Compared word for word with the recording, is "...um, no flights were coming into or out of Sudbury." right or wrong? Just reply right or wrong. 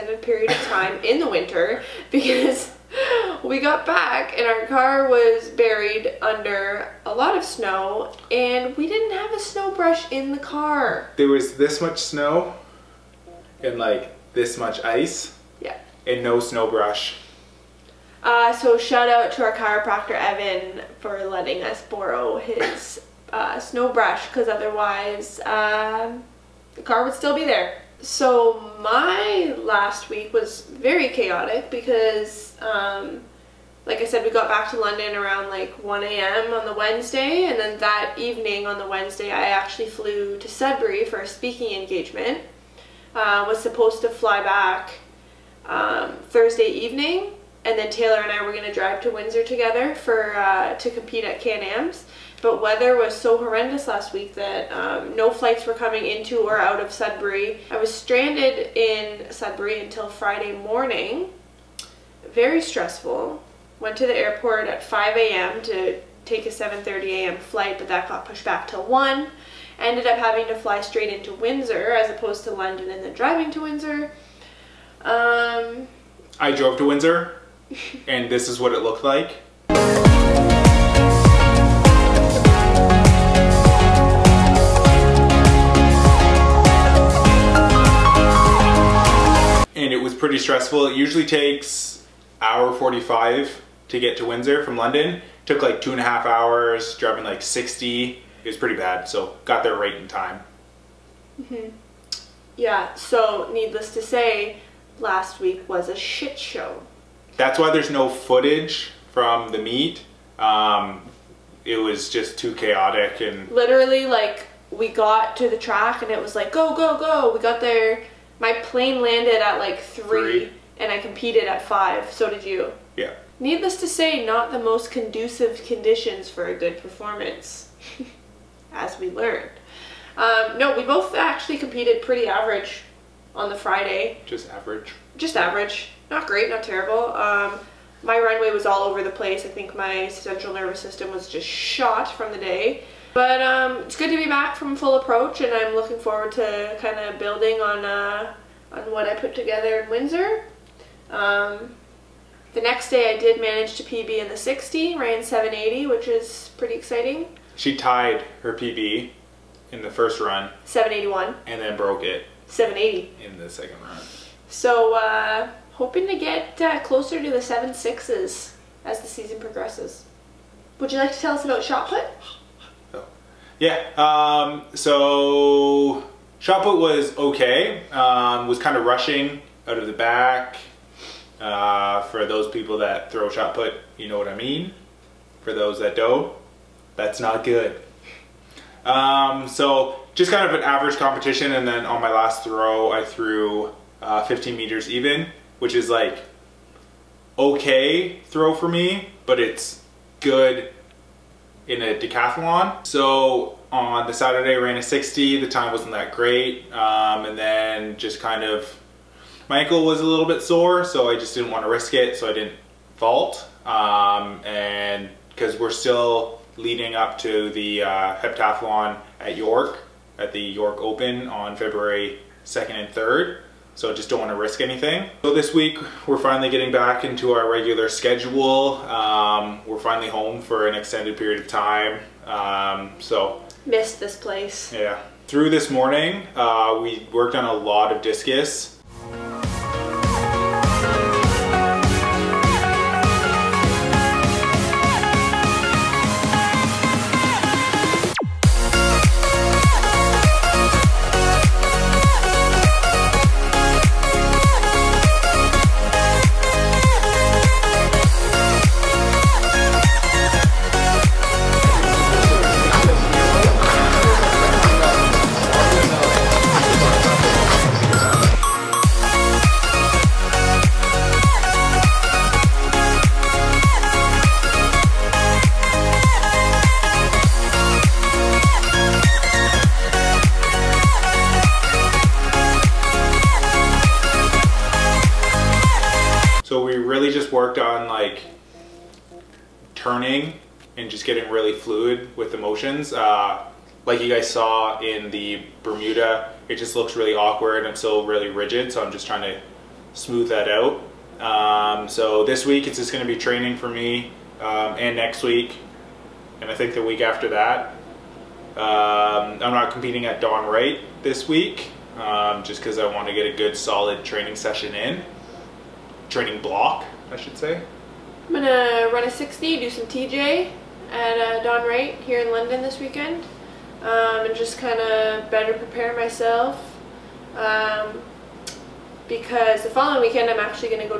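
right.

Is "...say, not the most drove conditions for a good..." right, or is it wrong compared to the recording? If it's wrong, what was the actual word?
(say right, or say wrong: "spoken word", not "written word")
wrong: "conducive", not "drove".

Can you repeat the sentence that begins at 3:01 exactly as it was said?
Uh, for those people that throw shot put, you know what I mean.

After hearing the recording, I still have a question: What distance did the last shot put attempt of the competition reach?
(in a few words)
15 meters.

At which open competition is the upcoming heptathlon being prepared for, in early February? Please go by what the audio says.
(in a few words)
York Open.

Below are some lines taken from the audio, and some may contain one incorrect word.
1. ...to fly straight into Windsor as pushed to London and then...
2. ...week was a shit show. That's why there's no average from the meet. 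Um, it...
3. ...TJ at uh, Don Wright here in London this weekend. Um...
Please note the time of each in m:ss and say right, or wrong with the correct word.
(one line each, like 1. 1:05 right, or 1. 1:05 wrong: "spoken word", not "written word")
1. 1:10 wrong: "opposed", not "pushed"
2. 1:45 wrong: "footage", not "average"
3. 5:19 right.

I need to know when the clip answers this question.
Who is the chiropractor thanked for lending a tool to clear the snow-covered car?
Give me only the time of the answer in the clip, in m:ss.
0:20.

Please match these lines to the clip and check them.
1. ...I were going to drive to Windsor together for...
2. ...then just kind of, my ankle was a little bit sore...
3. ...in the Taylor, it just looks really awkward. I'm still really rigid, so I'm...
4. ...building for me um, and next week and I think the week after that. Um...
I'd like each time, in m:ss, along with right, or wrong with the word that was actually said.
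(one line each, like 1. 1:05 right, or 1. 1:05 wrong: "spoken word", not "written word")
1. 0:48 right
2. 3:27 right
3. 4:54 wrong: "Bermuda", not "Taylor"
4. 5:03 wrong: "training", not "building".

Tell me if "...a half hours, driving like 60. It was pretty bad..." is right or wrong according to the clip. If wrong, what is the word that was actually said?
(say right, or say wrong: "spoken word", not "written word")
right.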